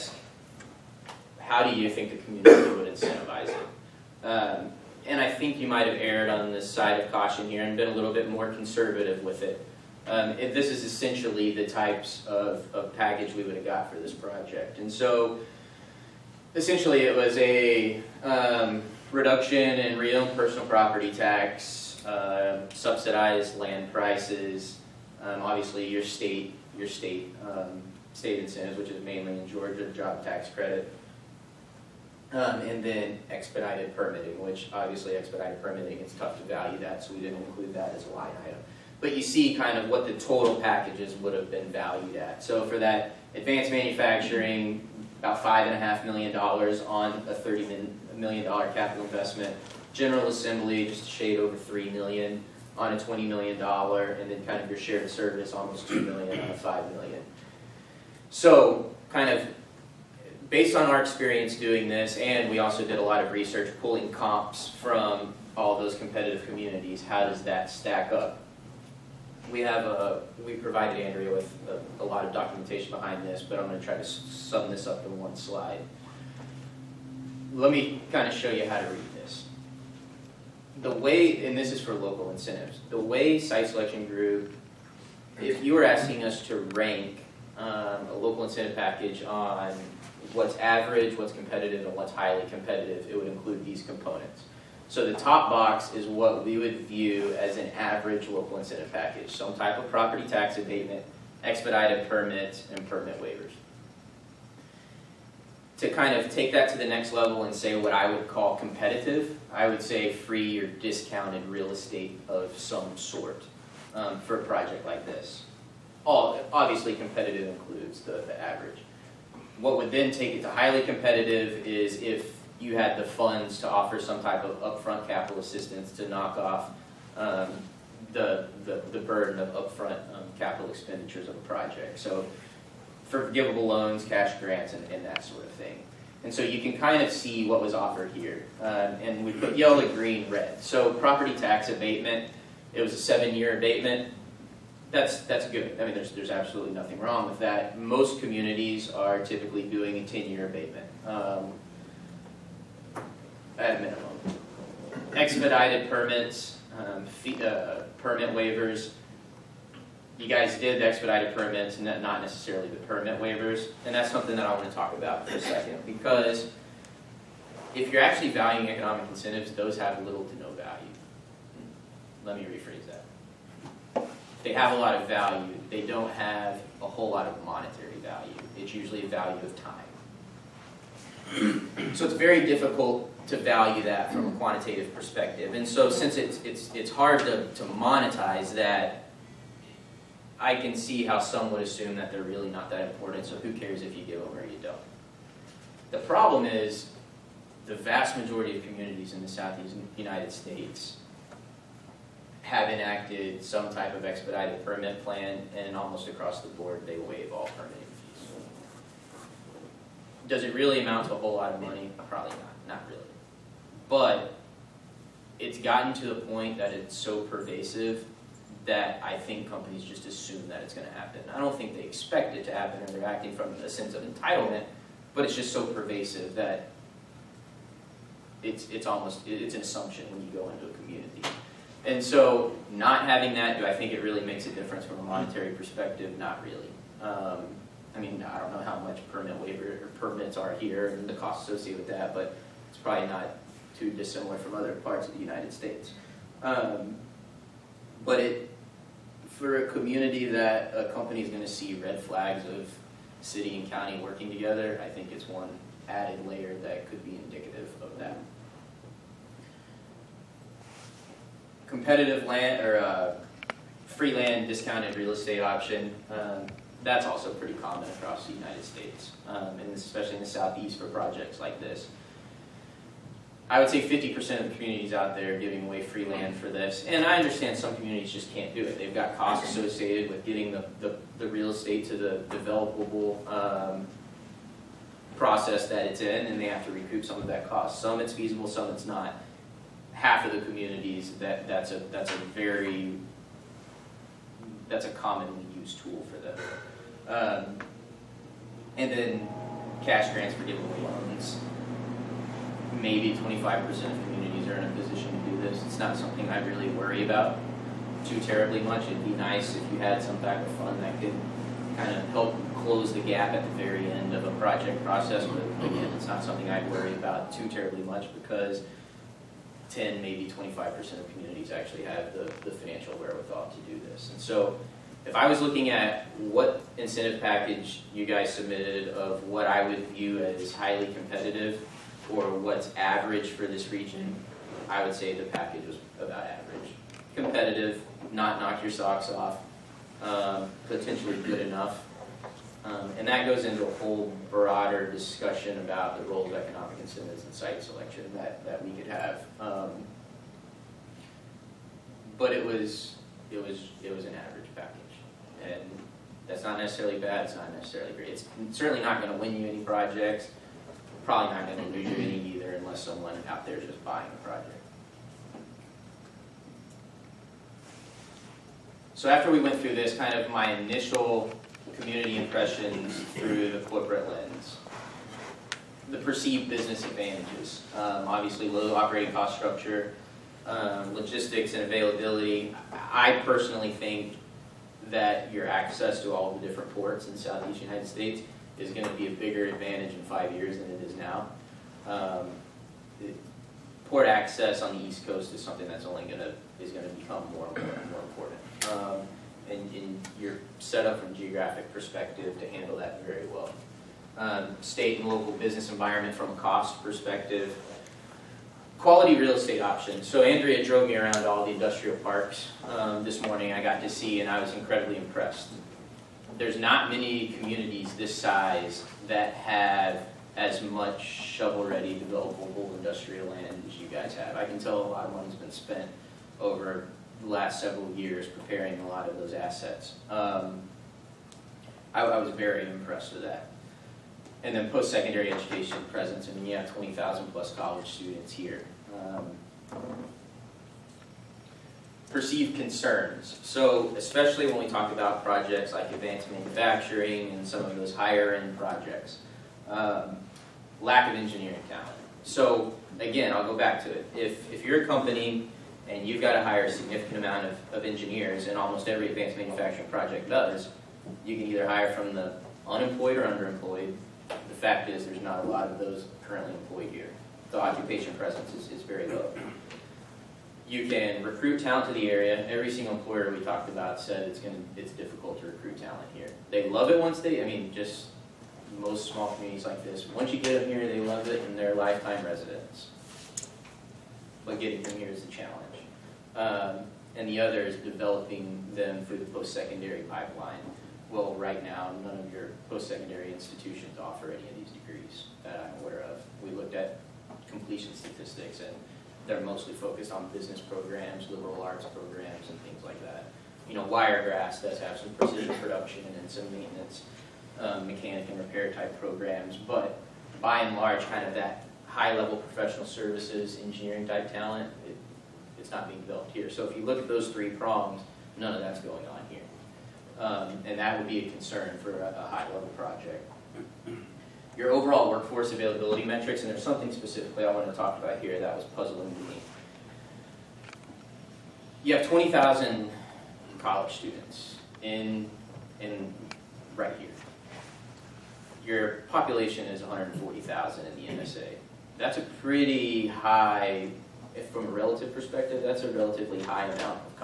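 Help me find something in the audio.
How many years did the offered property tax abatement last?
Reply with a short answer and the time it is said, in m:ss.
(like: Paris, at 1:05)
7 years, at 2:22.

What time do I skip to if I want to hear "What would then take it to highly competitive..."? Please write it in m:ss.
1:59.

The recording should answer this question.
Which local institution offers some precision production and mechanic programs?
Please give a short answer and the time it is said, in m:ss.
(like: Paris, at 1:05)
Wiregrass, at 8:23.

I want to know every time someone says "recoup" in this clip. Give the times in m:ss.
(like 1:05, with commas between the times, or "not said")
4:46.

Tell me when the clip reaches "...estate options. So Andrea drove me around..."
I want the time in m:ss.
6:49.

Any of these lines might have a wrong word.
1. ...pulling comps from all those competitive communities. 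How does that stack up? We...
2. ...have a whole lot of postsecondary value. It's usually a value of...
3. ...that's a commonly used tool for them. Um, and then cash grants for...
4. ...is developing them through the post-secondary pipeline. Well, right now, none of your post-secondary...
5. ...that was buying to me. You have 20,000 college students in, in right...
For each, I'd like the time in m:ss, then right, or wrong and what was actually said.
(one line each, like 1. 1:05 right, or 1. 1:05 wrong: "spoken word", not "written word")
1. 1:03 right
2. 2:56 wrong: "monetary", not "postsecondary"
3. 4:54 right
4. 8:07 right
5. 8:48 wrong: "puzzling", not "buying".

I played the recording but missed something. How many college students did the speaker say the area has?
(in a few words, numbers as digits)
20,000.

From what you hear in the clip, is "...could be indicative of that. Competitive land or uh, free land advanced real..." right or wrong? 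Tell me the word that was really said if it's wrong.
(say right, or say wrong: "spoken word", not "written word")
wrong: "discounted", not "advanced".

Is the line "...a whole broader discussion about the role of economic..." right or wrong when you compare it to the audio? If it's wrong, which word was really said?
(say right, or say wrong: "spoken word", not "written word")
right.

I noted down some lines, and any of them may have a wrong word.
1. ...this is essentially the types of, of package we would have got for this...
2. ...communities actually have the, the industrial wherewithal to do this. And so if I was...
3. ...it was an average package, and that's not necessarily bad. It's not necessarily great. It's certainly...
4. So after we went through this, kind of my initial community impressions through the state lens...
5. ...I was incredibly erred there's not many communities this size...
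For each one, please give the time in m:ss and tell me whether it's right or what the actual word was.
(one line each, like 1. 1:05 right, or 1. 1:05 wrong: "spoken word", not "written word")
1. 0:10 right
2. 5:21 wrong: "financial", not "industrial"
3. 5:53 right
4. 6:08 wrong: "corporate", not "state"
5. 6:54 wrong: "impressed", not "erred".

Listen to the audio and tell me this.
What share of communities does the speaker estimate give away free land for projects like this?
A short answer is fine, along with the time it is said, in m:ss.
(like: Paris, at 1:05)
50%, at 4:33.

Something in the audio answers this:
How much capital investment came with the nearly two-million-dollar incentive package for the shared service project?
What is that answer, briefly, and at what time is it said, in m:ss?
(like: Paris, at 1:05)
$5 million, at 0:56.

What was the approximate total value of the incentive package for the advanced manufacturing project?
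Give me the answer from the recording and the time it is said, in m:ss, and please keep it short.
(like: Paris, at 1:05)
$5.5 million, at 0:45.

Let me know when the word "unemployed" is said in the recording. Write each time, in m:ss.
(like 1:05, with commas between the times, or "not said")
7:42.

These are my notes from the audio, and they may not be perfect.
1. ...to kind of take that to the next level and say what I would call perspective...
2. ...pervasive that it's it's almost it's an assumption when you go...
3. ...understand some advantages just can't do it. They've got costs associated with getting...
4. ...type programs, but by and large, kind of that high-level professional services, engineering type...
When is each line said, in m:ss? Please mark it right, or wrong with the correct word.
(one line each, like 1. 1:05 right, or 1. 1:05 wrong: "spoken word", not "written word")
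1. 1:45 wrong: "competitive", not "perspective"
2. 3:45 right
3. 4:37 wrong: "communities", not "advantages"
4. 8:28 right.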